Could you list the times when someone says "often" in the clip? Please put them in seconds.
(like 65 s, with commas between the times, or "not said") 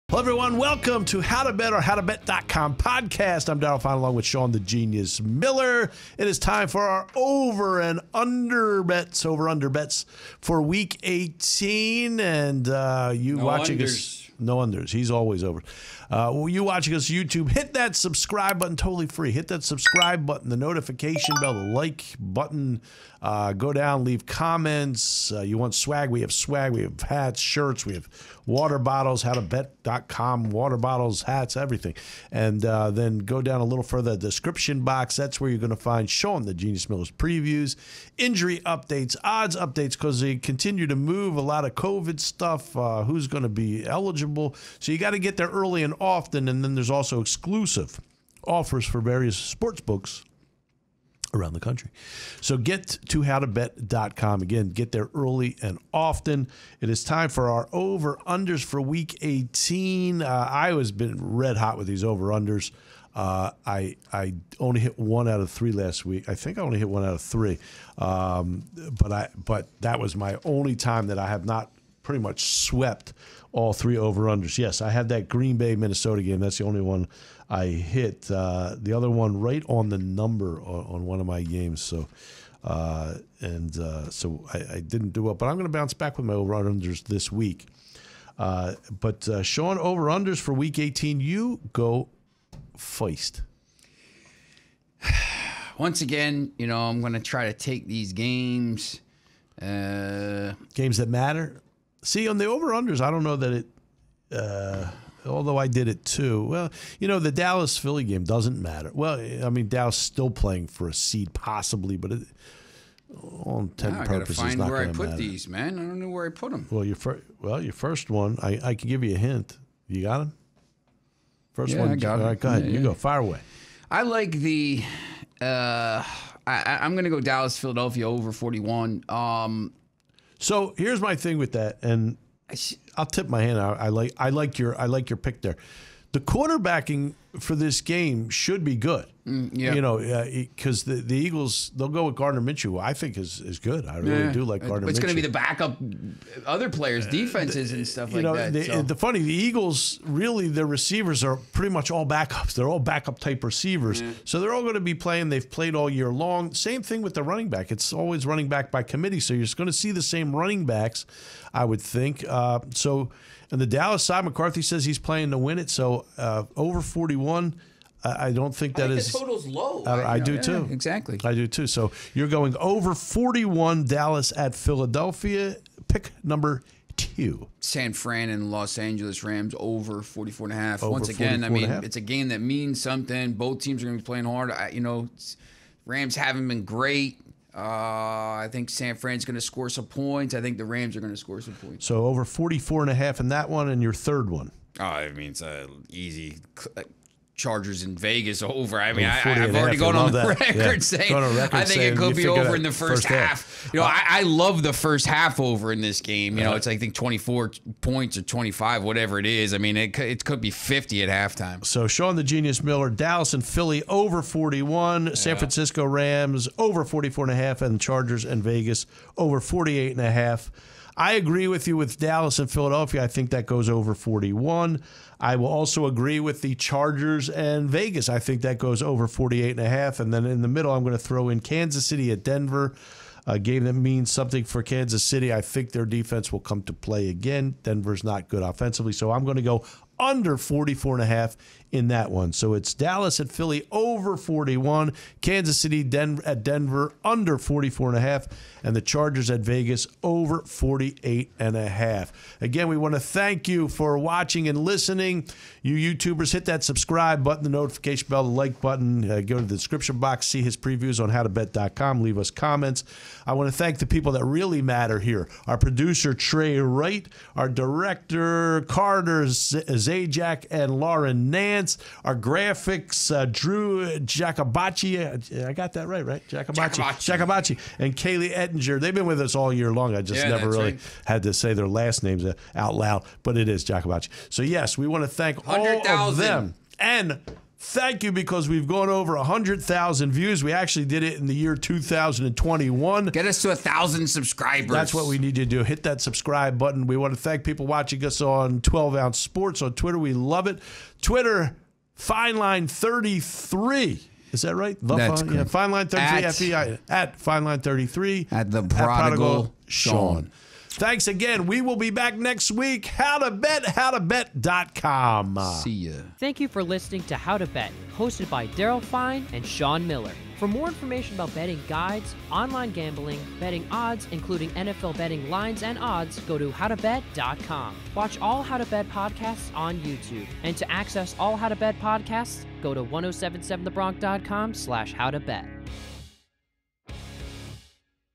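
45 s, 55 s.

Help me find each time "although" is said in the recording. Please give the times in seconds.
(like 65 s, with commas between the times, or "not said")
105 s.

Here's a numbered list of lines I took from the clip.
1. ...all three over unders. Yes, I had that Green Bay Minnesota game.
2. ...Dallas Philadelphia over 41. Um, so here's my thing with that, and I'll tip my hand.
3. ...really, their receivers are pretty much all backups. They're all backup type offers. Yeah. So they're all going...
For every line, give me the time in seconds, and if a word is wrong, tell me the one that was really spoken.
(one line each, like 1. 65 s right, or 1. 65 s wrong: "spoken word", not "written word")
1. 73 s right
2. 127 s right
3. 150 s wrong: "receivers", not "offers".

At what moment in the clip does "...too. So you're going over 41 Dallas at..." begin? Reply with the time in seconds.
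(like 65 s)
171 s.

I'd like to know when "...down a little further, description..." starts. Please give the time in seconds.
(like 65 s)
33 s.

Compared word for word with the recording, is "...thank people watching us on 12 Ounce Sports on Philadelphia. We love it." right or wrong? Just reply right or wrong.
wrong.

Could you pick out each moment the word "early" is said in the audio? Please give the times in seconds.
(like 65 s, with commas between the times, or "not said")
45 s, 55 s.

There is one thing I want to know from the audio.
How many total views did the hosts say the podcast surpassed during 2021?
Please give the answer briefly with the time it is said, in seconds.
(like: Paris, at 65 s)
100,000, at 289 s.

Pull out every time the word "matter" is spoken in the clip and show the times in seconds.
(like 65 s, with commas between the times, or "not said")
101 s, 108 s, 115 s, 264 s.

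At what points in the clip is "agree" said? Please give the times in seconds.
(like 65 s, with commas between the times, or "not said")
221 s, 225 s.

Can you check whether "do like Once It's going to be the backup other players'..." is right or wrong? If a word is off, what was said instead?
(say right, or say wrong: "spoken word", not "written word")
wrong: "Gardner", not "Once".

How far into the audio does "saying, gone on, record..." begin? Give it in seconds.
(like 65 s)
200 s.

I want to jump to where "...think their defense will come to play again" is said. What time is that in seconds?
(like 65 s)
235 s.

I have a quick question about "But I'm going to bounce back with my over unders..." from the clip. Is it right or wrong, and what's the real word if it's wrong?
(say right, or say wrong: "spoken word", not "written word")
right.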